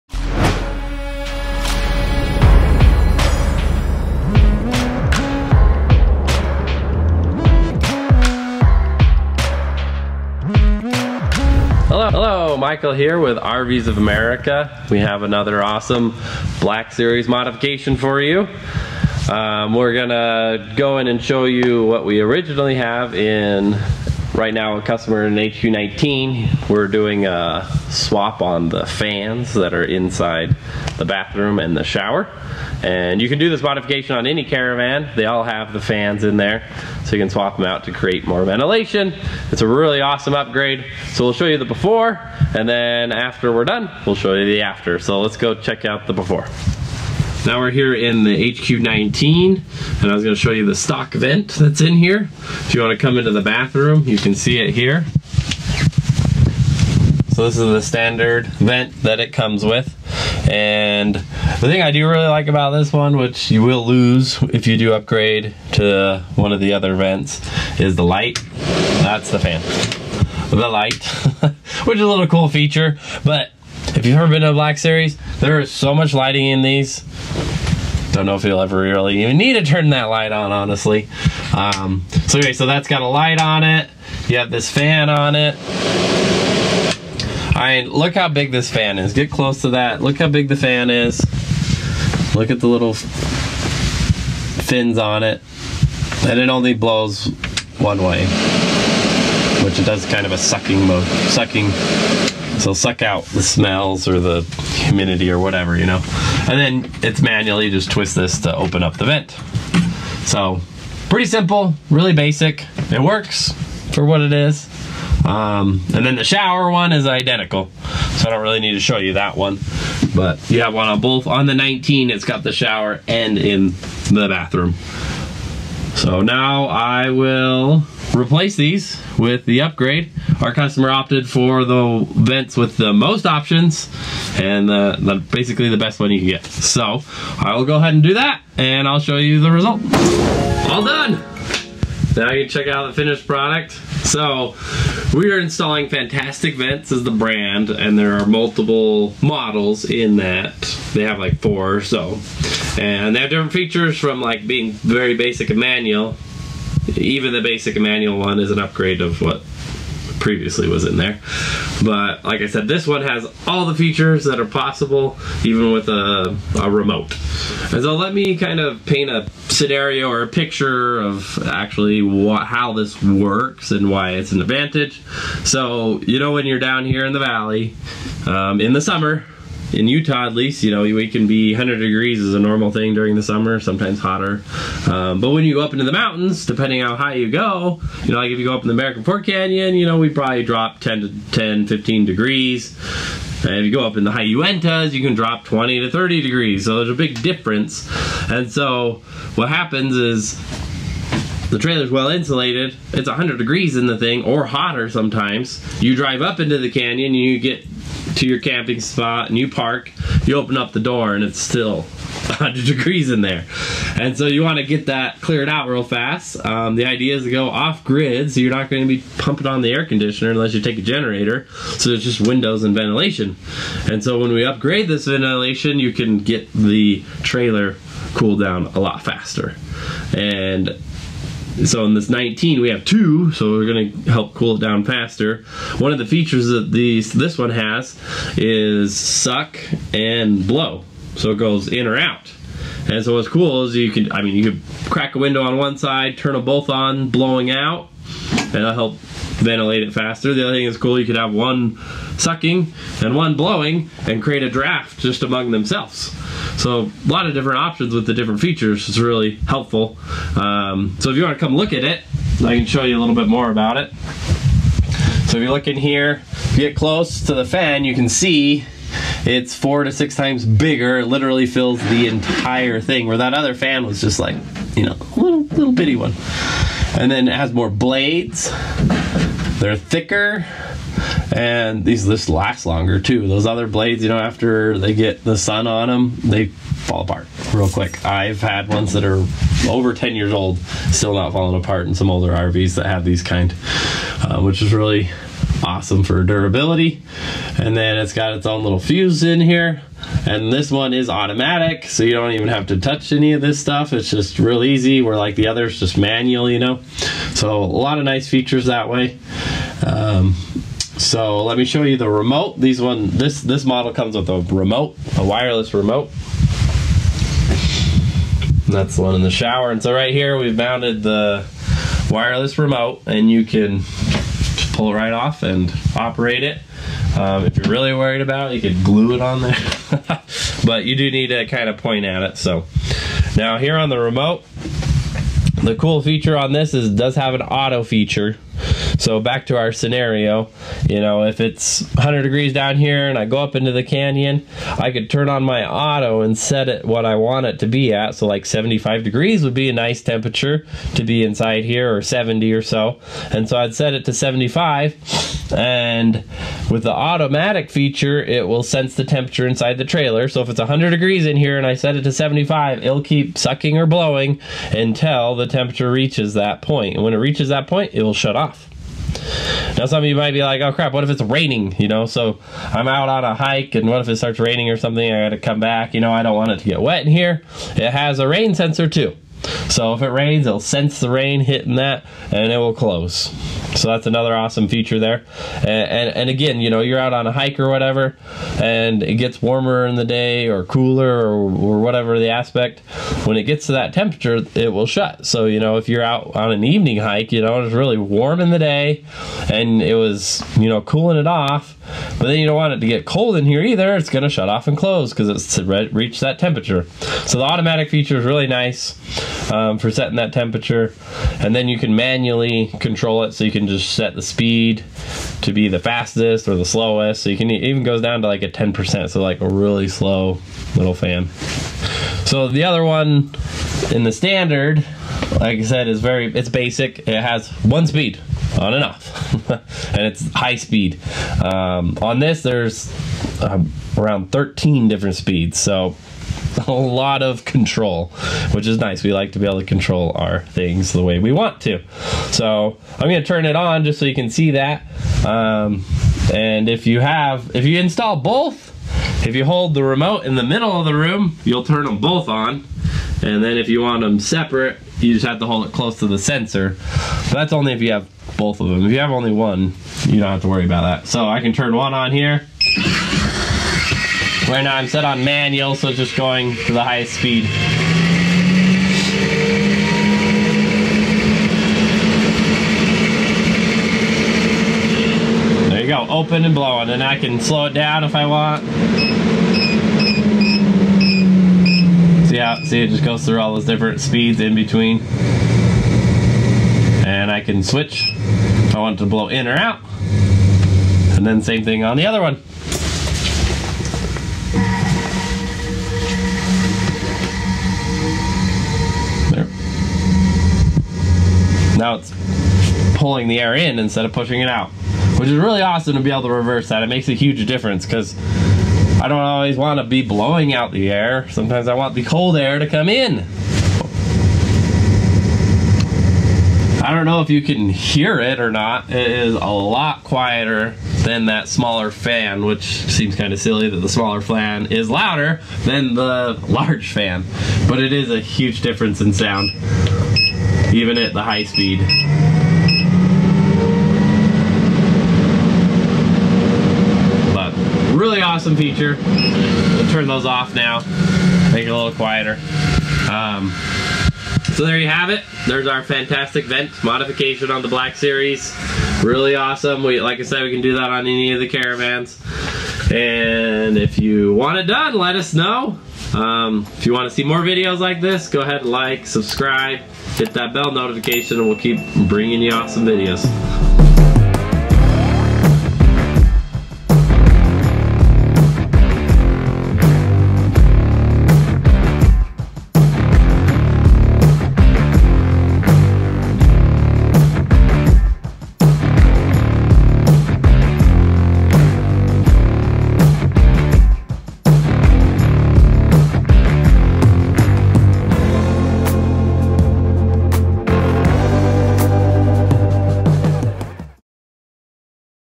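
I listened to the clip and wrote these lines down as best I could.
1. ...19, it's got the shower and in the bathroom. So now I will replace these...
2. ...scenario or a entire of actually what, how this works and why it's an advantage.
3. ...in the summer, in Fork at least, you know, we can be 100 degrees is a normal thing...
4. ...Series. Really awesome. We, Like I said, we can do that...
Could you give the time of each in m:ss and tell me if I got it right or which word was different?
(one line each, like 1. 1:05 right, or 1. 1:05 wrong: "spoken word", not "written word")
1. 2:01 right
2. 2:49 wrong: "picture", not "entire"
3. 2:58 wrong: "Utah", not "Fork"
4. 9:07 right.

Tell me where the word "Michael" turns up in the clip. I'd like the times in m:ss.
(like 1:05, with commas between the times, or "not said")
0:12.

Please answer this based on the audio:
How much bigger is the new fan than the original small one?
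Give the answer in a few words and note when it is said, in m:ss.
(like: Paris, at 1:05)
4 to 6 times, at 4:29.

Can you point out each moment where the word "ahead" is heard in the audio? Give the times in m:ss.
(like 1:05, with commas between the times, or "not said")
2:17, 9:18.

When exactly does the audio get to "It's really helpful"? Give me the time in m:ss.
4:18.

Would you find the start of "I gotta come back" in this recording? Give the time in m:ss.
6:15.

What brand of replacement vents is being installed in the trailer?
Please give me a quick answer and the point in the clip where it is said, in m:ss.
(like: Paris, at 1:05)
Fantastic Vents, at 2:25.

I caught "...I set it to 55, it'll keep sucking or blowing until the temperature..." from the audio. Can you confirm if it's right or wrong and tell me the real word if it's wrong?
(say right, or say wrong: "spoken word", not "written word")
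wrong: "75", not "55".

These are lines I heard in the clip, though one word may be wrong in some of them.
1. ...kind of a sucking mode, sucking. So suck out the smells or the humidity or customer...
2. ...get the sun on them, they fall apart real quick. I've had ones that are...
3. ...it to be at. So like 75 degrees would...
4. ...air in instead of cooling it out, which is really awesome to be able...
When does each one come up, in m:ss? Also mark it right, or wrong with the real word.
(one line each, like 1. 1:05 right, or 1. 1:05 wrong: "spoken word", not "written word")
1. 1:40 wrong: "whatever", not "customer"
2. 4:44 right
3. 5:47 right
4. 8:23 wrong: "pushing", not "cooling".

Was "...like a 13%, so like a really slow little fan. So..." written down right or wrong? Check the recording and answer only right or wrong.
wrong.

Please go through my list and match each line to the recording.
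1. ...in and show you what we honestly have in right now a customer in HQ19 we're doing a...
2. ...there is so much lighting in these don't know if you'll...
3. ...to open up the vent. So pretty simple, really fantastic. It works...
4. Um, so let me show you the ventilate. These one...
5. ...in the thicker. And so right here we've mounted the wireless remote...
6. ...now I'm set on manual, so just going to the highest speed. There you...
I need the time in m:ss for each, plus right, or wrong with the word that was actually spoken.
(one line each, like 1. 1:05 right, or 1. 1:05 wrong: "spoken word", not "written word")
1. 0:20 wrong: "originally", not "honestly"
2. 1:15 right
3. 1:48 wrong: "basic", not "fantastic"
4. 5:09 wrong: "remote", not "ventilate"
5. 5:19 wrong: "shower", not "thicker"
6. 7:44 right.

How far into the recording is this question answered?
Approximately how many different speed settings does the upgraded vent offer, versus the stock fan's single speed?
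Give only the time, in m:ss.
7:14.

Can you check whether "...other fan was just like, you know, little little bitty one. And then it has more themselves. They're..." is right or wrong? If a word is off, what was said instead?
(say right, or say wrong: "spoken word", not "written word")
wrong: "blades", not "themselves".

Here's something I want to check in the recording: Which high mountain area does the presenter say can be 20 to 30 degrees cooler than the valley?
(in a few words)
High Uintas.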